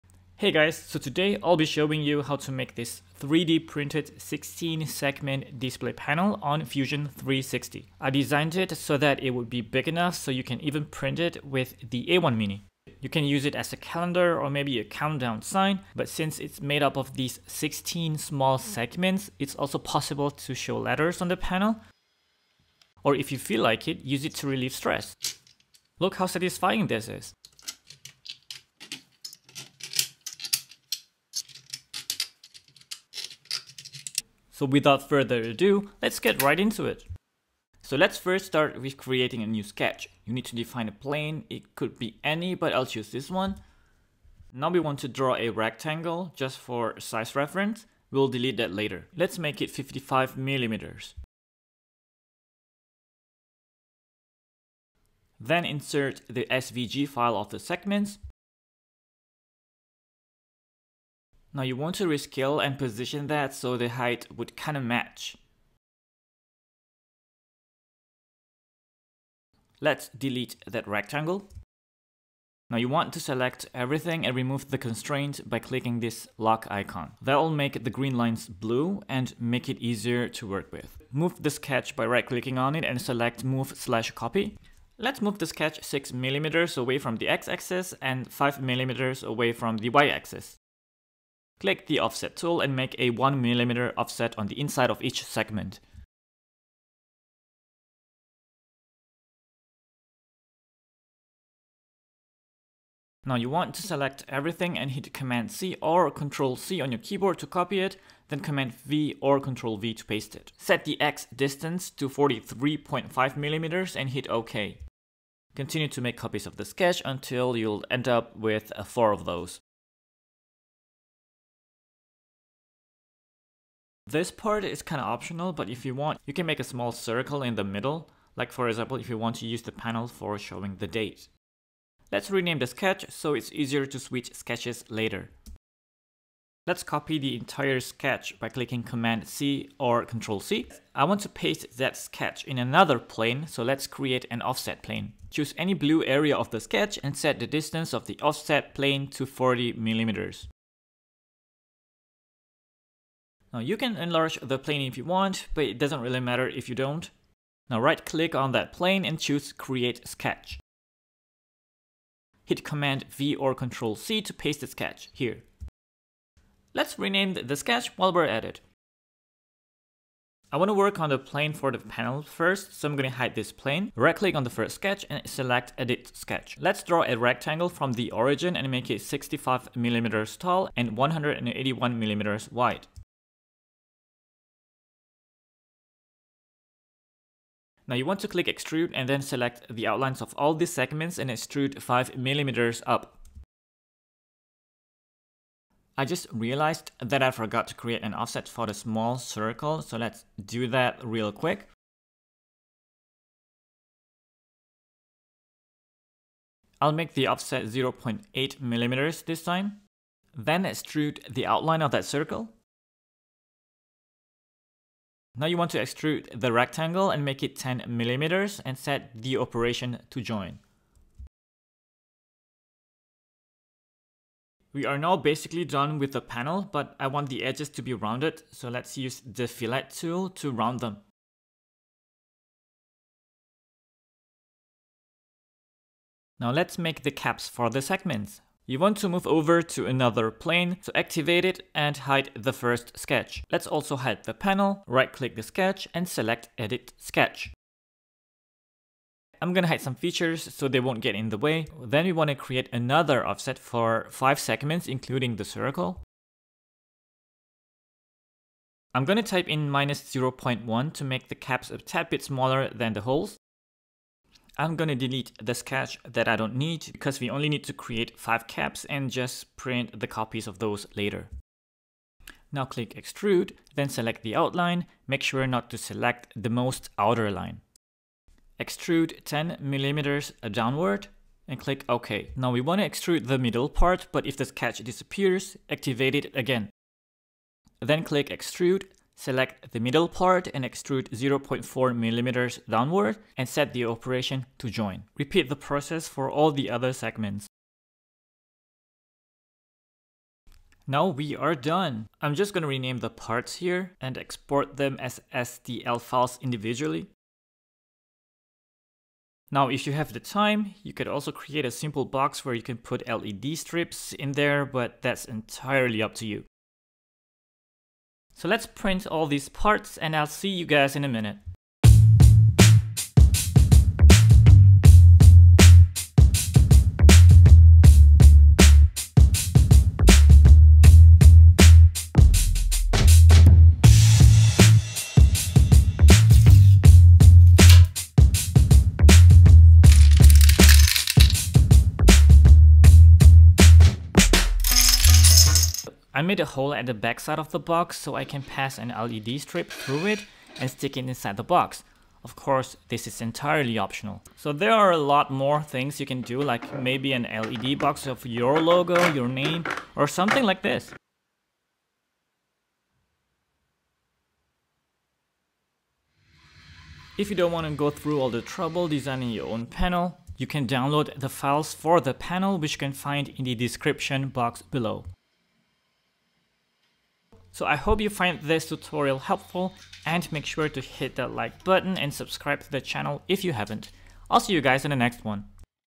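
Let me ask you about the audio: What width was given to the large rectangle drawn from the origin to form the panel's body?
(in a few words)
181 millimeters.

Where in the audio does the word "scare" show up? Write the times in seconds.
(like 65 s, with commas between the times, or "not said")
not said.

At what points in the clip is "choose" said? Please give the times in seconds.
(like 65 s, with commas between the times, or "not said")
42 s, 145 s, 159 s.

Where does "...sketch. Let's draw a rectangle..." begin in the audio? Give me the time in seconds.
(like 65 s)
176 s.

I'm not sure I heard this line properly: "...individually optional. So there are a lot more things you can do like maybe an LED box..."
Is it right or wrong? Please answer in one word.
wrong.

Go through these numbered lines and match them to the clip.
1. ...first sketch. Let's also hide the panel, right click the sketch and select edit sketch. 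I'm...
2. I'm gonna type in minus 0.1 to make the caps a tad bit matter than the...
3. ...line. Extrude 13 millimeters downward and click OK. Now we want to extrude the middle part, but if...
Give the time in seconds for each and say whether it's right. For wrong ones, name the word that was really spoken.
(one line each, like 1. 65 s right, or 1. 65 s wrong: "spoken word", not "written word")
1. 242 s right
2. 258 s wrong: "smaller", not "matter"
3. 277 s wrong: "10", not "13".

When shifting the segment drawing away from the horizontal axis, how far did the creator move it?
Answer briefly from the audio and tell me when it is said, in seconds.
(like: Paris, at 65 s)
6 millimeters, at 85 s.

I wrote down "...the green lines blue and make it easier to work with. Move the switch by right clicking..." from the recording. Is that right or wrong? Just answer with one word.
wrong.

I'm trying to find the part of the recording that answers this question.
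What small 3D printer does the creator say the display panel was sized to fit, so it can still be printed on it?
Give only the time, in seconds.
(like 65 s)
12 s.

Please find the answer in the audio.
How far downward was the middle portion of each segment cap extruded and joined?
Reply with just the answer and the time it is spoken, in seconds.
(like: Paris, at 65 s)
0.4 millimeters, at 291 s.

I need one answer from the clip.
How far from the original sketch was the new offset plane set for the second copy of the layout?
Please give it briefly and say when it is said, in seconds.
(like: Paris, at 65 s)
40 millimeters, at 149 s.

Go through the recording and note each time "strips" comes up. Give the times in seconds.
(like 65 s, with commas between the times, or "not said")
313 s, 349 s.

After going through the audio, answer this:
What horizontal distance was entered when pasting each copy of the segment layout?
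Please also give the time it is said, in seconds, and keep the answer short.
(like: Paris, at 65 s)
43.5 millimeters, at 112 s.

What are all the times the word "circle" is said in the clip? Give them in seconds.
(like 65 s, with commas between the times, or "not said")
126 s, 199 s, 212 s, 255 s.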